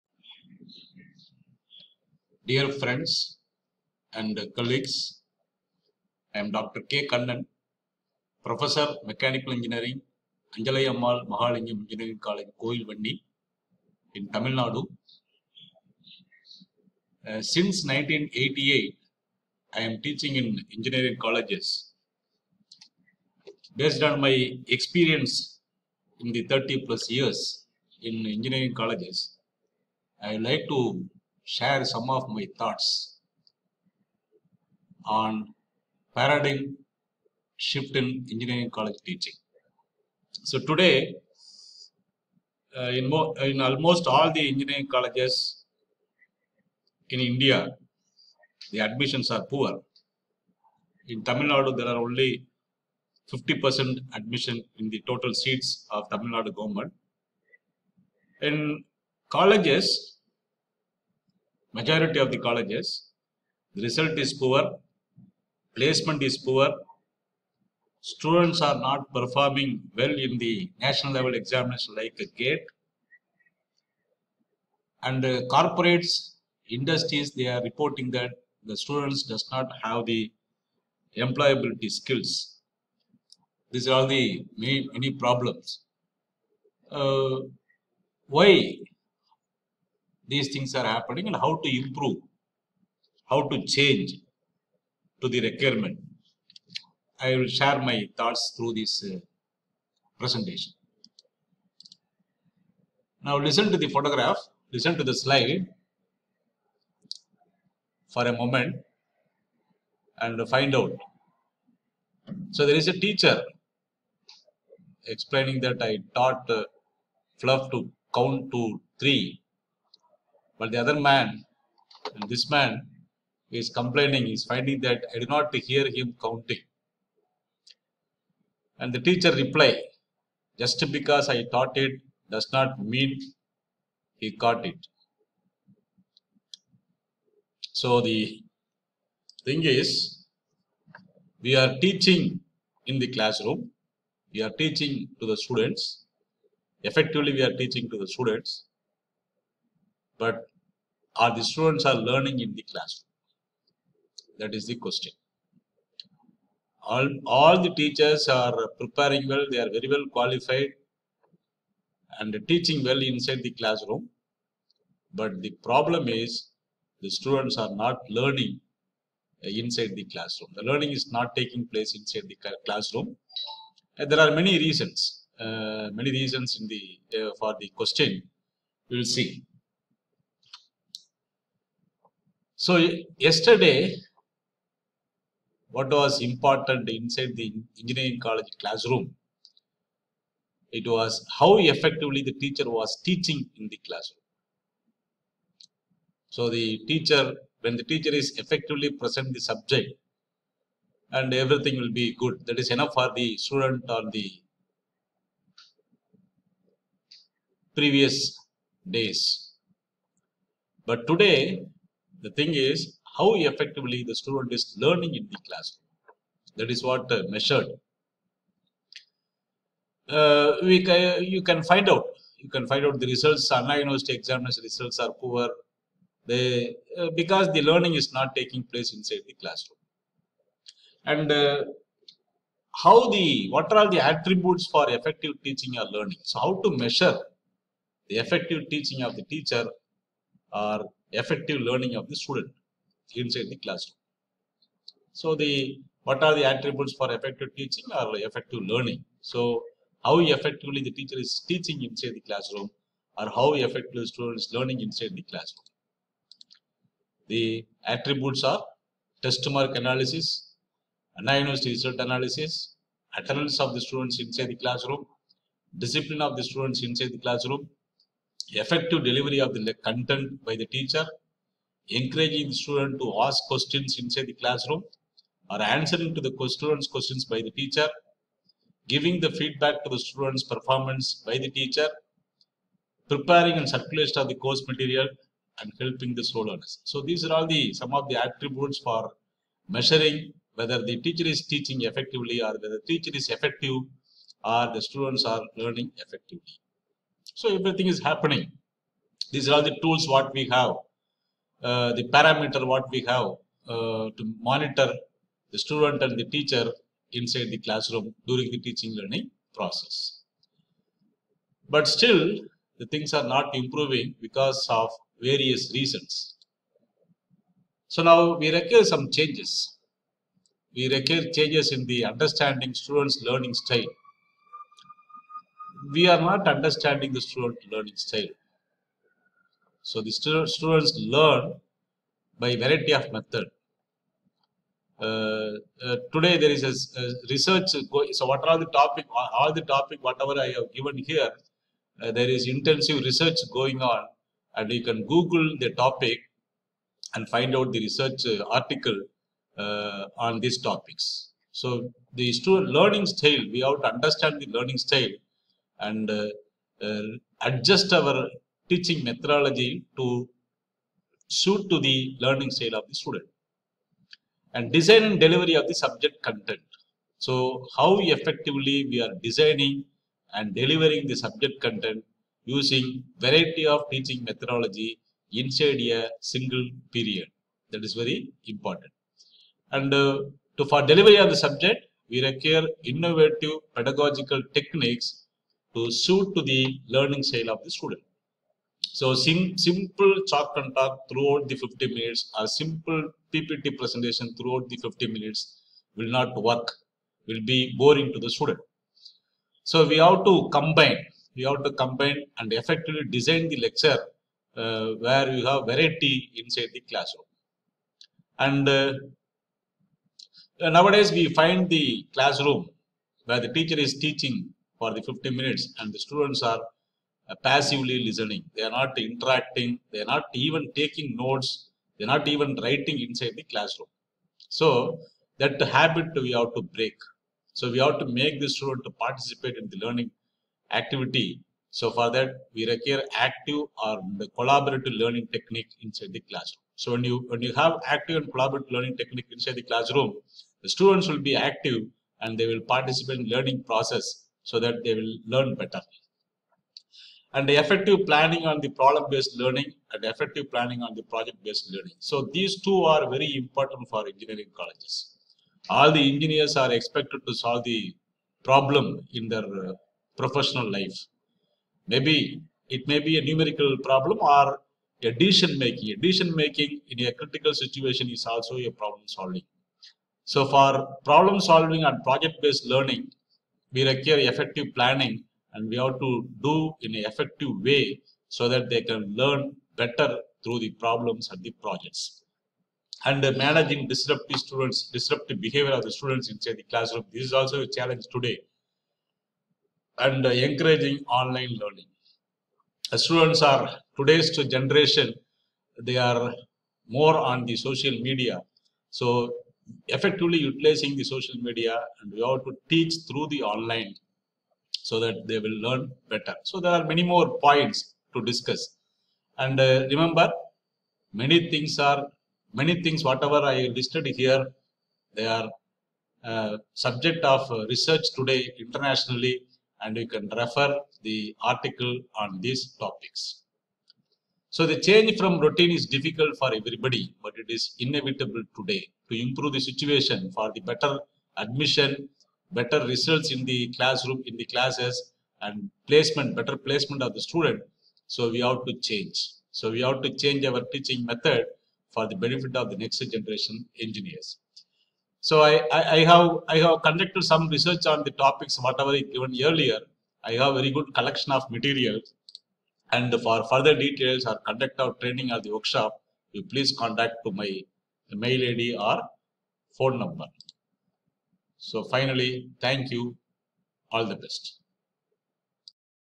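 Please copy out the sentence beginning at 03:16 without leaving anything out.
So, the teacher, when the teacher is effectively present the subject, and everything will be good.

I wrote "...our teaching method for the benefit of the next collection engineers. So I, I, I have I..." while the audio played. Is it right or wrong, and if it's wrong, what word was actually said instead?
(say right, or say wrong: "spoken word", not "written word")
wrong: "generation", not "collection".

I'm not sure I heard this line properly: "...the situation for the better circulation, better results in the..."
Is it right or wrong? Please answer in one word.
wrong.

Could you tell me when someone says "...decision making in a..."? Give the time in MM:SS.
07:45.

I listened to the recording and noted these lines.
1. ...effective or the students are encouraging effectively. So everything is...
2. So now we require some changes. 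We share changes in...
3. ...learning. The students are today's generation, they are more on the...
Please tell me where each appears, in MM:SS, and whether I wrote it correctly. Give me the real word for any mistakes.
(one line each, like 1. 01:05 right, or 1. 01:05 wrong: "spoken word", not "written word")
1. 04:53 wrong: "learning", not "encouraging"
2. 05:17 wrong: "require", not "share"
3. 08:11 right.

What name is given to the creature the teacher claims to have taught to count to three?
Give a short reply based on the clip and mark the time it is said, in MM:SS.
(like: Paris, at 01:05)
Fluff, at 01:57.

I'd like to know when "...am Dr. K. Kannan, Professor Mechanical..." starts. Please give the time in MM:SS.
00:06.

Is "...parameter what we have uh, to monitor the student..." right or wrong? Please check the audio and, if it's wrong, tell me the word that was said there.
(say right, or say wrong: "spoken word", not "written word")
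right.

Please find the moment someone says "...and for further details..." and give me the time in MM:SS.
09:12.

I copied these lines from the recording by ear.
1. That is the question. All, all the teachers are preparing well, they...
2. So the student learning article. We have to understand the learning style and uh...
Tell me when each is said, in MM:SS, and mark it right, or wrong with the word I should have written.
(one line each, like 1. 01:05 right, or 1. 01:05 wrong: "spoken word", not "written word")
1. 02:34 right
2. 05:51 wrong: "style", not "article".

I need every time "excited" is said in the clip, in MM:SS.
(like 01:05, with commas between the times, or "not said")
not said.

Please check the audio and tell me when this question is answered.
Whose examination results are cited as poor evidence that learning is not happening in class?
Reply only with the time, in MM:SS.
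03:43.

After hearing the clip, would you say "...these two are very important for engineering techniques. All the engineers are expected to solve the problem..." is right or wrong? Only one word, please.
wrong.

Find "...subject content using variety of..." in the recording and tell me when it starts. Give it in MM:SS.
06:11.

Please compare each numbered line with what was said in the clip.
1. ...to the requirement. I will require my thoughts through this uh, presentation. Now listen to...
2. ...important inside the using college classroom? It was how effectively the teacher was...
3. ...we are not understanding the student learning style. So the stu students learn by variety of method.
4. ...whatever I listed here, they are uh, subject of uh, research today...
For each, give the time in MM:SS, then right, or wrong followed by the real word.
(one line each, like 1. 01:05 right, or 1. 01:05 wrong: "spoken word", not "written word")
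1. 01:35 wrong: "share", not "require"
2. 03:06 wrong: "engineering", not "using"
3. 05:25 right
4. 08:33 right.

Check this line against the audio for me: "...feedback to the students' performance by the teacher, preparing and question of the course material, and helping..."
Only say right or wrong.
wrong.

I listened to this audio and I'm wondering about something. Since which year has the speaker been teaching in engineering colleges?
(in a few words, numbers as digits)
1988.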